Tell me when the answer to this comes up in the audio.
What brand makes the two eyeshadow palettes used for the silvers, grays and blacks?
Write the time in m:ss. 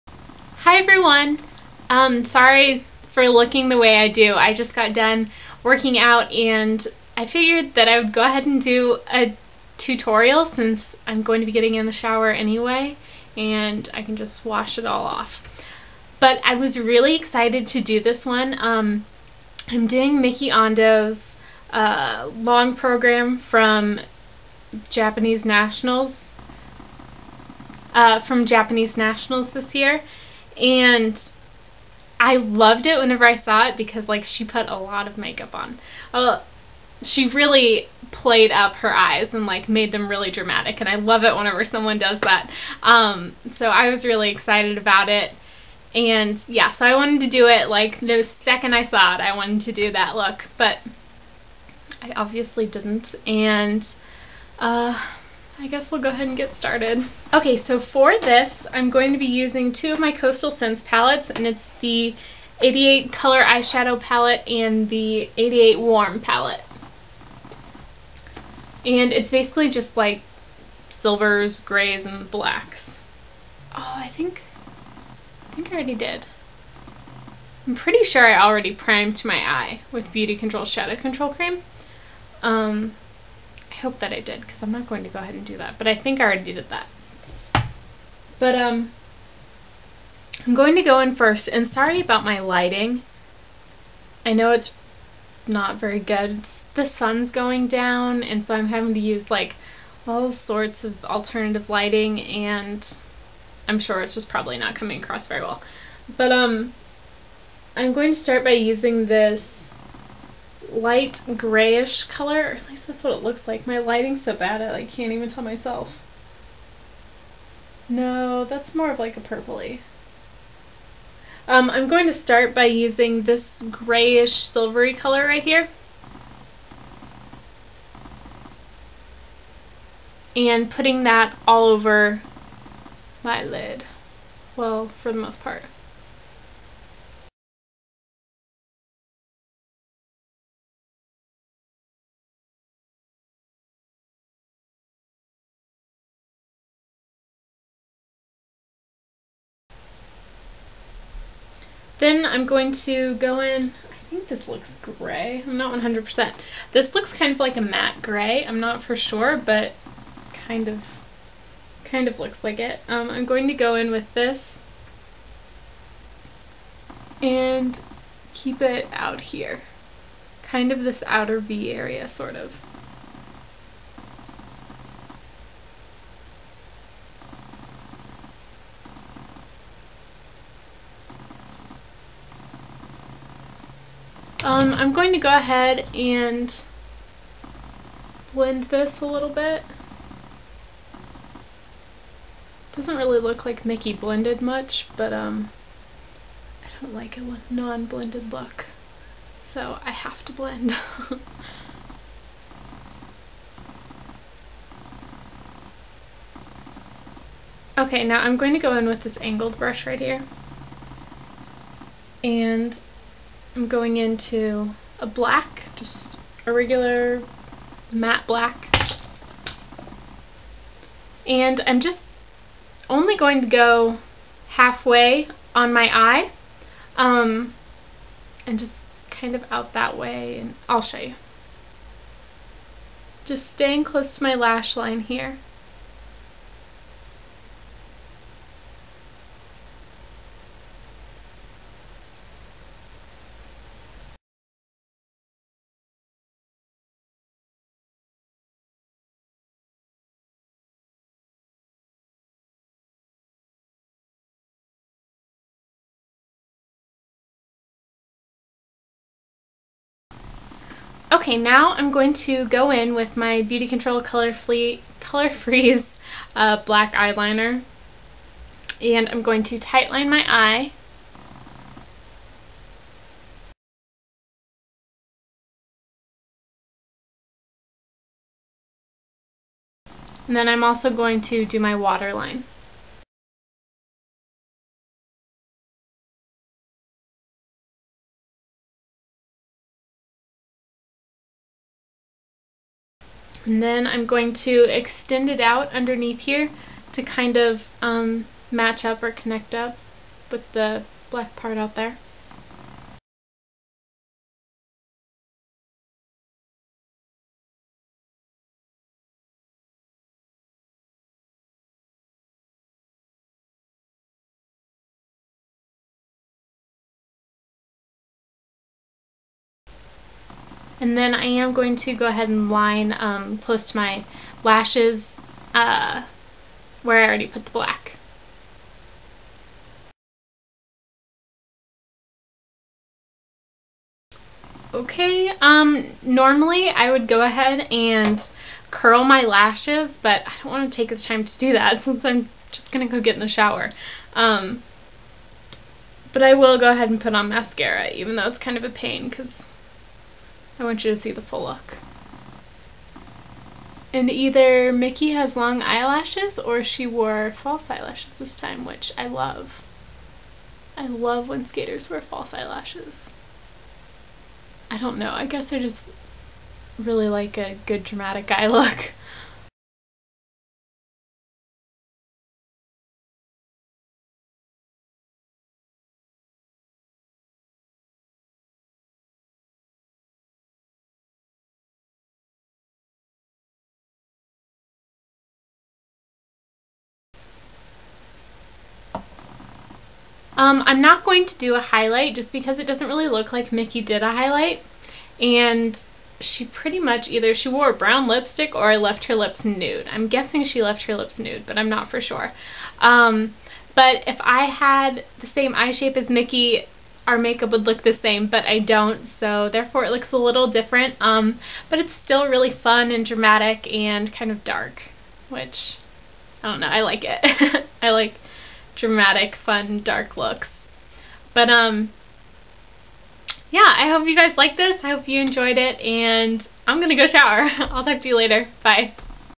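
1:00.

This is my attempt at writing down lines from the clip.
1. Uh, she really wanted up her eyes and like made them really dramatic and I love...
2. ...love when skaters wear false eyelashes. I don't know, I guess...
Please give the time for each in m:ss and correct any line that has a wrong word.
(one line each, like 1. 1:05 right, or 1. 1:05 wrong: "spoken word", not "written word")
1. 0:36 wrong: "played", not "wanted"
2. 6:00 right.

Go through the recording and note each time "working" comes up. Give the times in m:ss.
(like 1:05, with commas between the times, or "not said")
0:05.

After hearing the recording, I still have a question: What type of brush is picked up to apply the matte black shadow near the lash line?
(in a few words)
angled brush.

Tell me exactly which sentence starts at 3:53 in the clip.
Just staying close to my lash line here.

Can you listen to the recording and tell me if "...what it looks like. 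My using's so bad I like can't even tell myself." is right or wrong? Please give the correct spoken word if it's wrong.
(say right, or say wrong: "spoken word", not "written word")
wrong: "lighting", not "using".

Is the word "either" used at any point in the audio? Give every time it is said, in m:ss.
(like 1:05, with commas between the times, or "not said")
5:54, 6:37.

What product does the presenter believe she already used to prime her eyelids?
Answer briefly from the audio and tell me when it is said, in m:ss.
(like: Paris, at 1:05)
BeautiControl Shadow Control Cream, at 1:20.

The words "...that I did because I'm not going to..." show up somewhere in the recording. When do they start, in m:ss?
1:23.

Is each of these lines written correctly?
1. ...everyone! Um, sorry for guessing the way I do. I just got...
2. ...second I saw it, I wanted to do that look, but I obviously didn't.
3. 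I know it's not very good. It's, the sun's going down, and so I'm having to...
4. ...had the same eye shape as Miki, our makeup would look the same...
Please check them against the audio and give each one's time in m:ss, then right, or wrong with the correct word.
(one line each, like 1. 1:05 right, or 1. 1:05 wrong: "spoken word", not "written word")
1. 0:00 wrong: "looking", not "guessing"
2. 0:48 right
3. 1:34 right
4. 6:44 right.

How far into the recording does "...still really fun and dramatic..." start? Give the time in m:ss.
6:51.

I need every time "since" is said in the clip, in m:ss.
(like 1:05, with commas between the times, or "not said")
0:10, 5:41.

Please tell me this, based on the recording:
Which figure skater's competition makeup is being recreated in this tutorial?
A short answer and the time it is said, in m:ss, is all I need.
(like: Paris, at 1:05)
Miki Ando, at 0:20.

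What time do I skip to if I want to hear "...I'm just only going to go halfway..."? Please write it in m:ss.
3:41.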